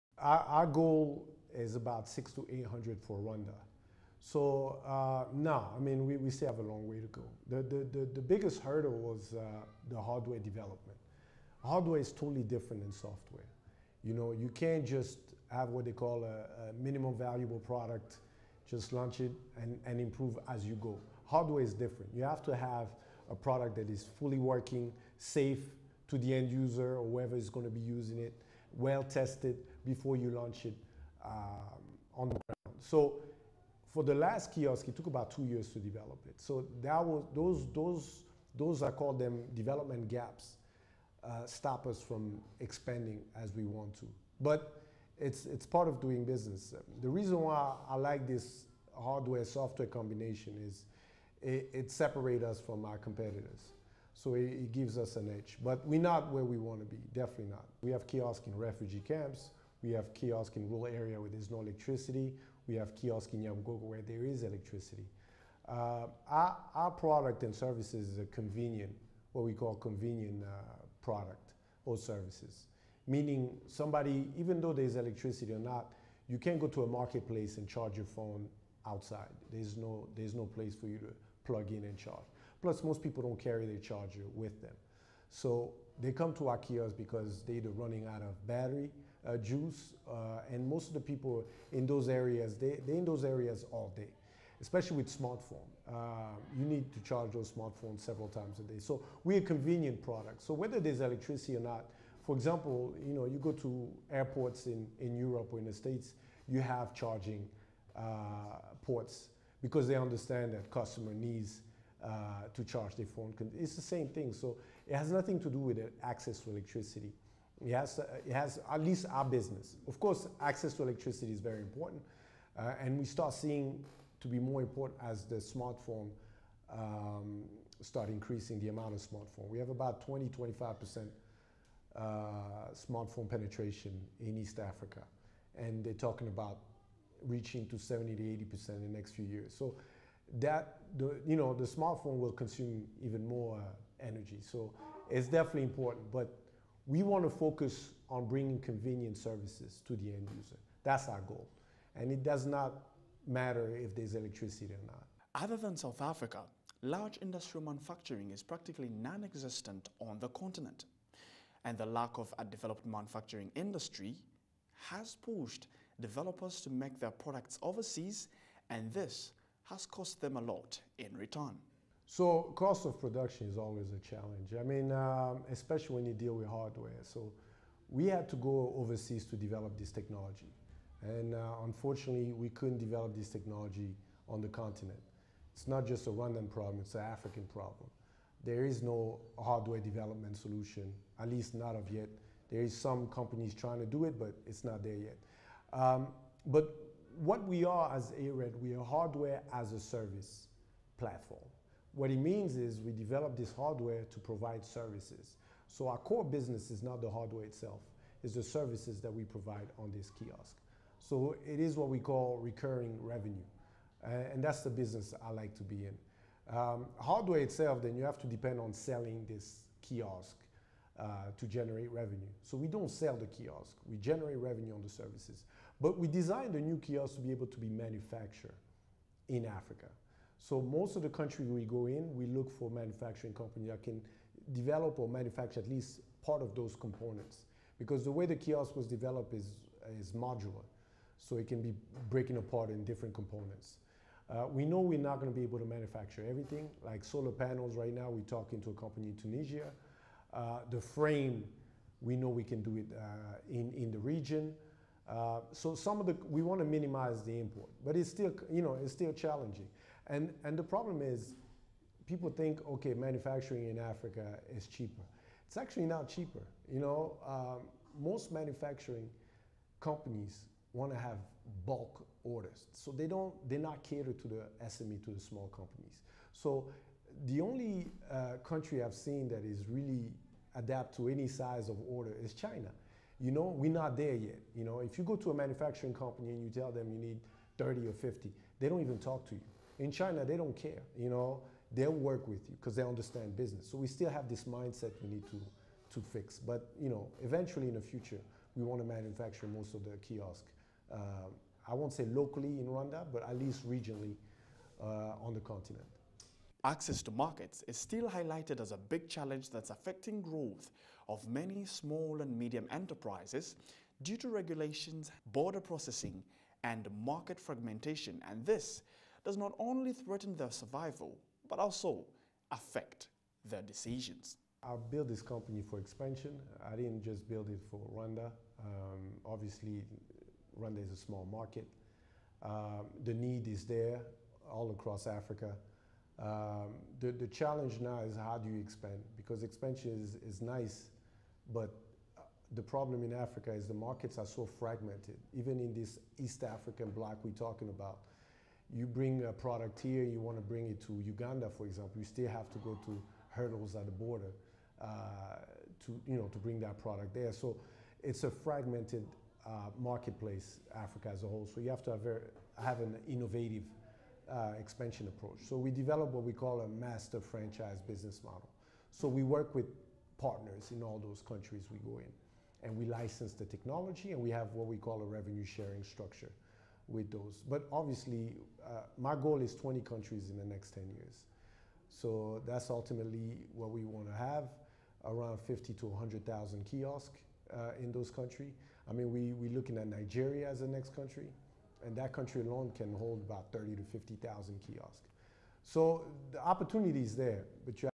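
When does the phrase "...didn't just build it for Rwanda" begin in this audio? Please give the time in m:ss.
5:26.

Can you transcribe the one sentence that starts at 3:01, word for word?
And uh, unfortunately, we couldn't develop this technology on the continent.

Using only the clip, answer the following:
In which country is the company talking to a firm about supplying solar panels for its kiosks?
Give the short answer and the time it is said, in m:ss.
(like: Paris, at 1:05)
Tunisia, at 4:09.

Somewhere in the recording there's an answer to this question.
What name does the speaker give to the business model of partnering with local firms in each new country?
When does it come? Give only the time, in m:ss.
6:06.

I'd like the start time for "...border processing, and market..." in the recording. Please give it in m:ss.
5:15.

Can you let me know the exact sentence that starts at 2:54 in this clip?
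I mean, um, especially when you deal with hardware.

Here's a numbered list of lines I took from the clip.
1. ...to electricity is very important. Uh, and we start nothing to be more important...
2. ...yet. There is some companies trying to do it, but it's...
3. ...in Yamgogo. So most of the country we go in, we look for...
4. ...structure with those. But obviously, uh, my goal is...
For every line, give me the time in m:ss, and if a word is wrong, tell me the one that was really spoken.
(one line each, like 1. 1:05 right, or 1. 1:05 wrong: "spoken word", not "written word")
1. 2:00 wrong: "seeing", not "nothing"
2. 3:11 right
3. 3:49 wrong: "Africa", not "Yamgogo"
4. 6:15 right.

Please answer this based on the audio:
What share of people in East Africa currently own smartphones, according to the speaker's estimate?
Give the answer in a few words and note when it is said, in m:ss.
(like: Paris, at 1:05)
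20-25%, at 2:10.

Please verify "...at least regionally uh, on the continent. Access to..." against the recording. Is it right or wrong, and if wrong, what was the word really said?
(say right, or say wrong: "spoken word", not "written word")
right.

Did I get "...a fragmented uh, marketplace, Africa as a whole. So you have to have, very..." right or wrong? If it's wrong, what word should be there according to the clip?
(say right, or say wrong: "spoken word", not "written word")
right.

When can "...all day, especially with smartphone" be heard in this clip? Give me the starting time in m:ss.
1:33.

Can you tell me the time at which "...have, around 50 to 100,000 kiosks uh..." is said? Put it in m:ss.
6:24.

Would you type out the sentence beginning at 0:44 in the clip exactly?
But it's it's part of doing business.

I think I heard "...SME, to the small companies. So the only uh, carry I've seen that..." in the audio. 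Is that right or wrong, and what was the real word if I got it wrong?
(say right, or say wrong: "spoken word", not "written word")
wrong: "country", not "carry".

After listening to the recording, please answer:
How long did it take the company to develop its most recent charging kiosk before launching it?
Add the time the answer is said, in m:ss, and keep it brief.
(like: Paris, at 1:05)
2 years, at 0:35.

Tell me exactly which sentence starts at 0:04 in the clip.
So uh, no, I mean, we, we still have a long way to go.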